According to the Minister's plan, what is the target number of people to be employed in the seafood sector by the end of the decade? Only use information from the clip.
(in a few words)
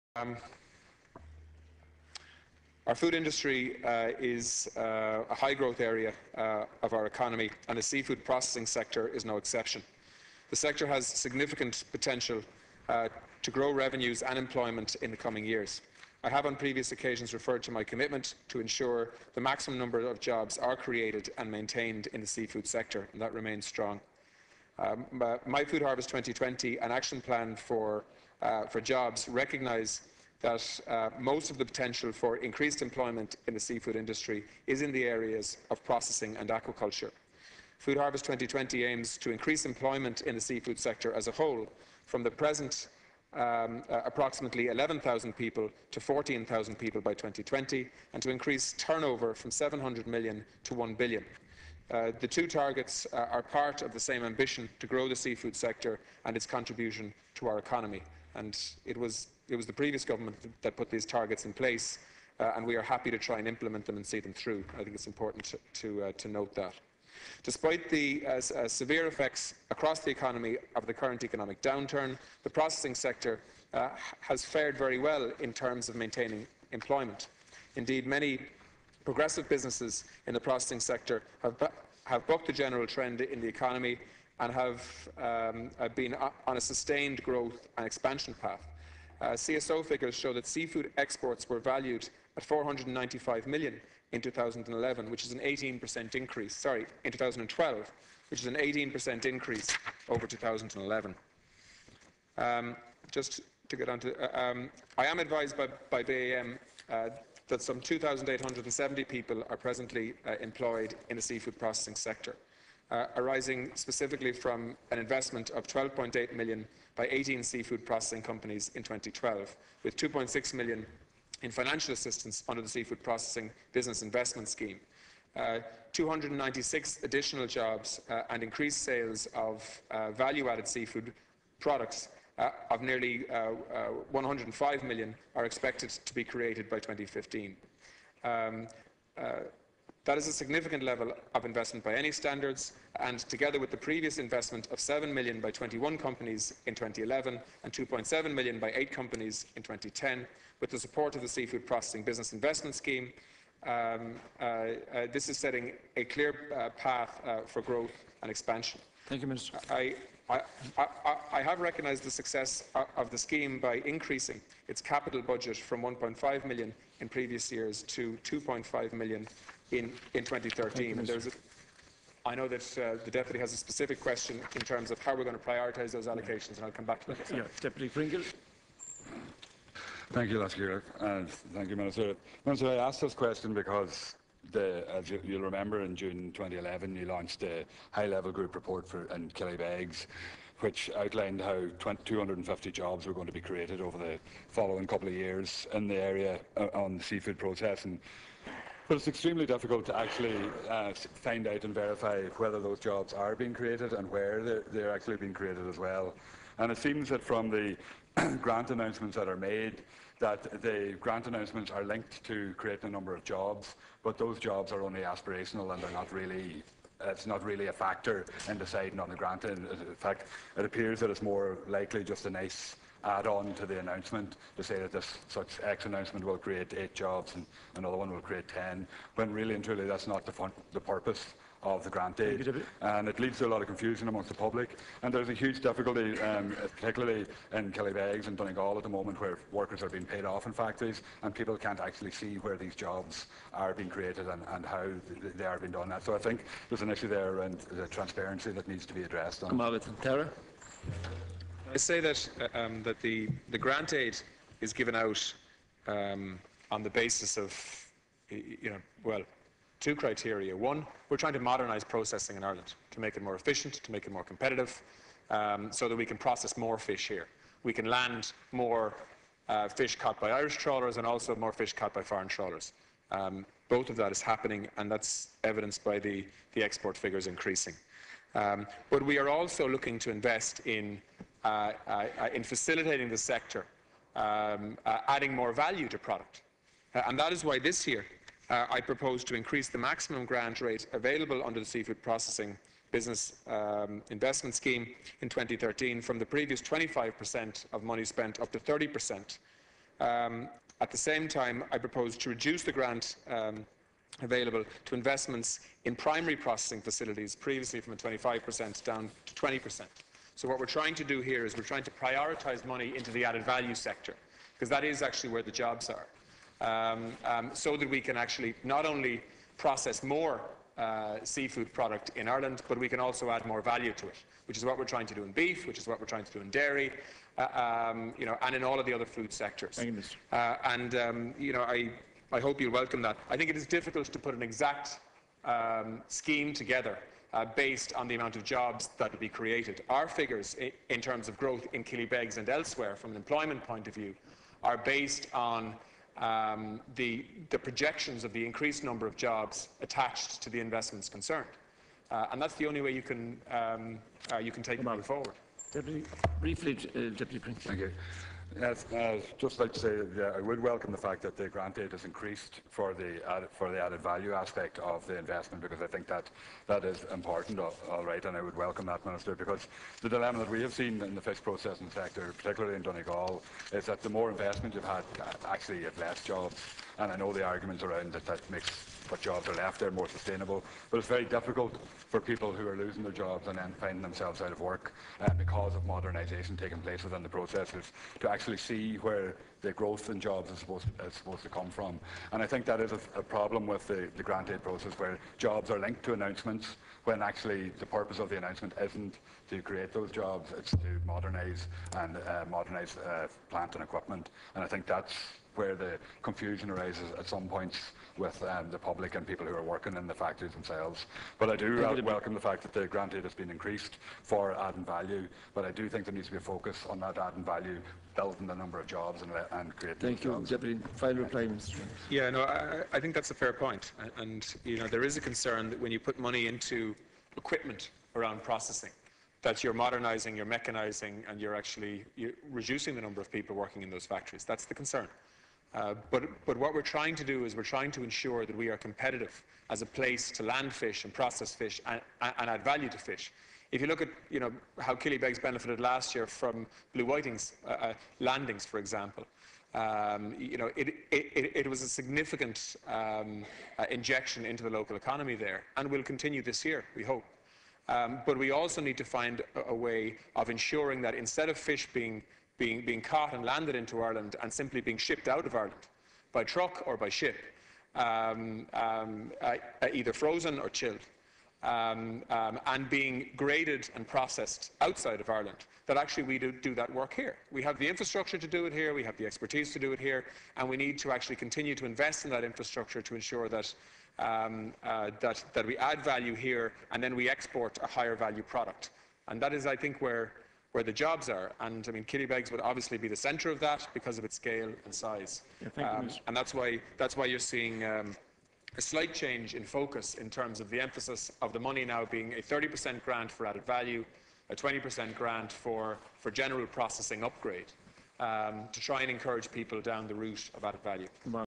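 14,000.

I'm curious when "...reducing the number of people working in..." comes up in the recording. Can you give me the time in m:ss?
7:12.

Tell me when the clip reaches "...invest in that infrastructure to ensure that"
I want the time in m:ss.
8:01.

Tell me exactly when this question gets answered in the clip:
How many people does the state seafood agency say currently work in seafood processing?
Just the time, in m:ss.
1:47.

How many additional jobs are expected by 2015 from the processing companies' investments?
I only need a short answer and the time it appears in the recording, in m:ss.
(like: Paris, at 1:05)
296, at 2:05.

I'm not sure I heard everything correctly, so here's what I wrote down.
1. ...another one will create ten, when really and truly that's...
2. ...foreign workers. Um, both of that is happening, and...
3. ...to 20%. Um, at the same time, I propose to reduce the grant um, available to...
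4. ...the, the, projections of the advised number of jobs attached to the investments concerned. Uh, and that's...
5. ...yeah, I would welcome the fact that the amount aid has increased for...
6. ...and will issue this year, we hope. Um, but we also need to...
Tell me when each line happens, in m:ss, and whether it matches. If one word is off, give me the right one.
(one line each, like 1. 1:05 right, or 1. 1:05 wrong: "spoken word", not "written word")
1. 3:47 right
2. 4:32 wrong: "trawlers", not "workers"
3. 4:58 wrong: "30", not "20"
4. 5:46 wrong: "increased", not "advised"
5. 6:00 wrong: "grant", not "amount"
6. 7:35 wrong: "continue", not "issue".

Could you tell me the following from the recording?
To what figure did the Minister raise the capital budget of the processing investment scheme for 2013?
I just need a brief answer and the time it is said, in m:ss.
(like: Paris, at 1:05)
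2.5 million, at 2:48.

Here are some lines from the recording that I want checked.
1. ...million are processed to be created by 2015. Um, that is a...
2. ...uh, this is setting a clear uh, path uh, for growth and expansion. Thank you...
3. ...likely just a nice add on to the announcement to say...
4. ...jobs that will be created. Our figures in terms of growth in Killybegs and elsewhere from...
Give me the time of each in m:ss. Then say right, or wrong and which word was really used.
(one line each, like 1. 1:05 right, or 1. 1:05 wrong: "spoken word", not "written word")
1. 2:14 wrong: "expected", not "processed"
2. 2:34 right
3. 3:41 right
4. 5:38 right.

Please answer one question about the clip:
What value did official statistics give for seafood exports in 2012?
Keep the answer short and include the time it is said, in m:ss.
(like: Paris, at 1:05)
495 million, at 1:32.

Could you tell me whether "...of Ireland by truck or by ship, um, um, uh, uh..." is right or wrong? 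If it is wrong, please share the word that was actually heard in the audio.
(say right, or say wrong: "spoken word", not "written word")
right.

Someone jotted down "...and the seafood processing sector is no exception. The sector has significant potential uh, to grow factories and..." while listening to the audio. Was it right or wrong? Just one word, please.
wrong.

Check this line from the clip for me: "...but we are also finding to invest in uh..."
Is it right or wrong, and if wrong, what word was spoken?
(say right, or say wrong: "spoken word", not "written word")
wrong: "looking", not "finding".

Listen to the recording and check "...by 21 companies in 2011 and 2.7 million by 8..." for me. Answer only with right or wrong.
right.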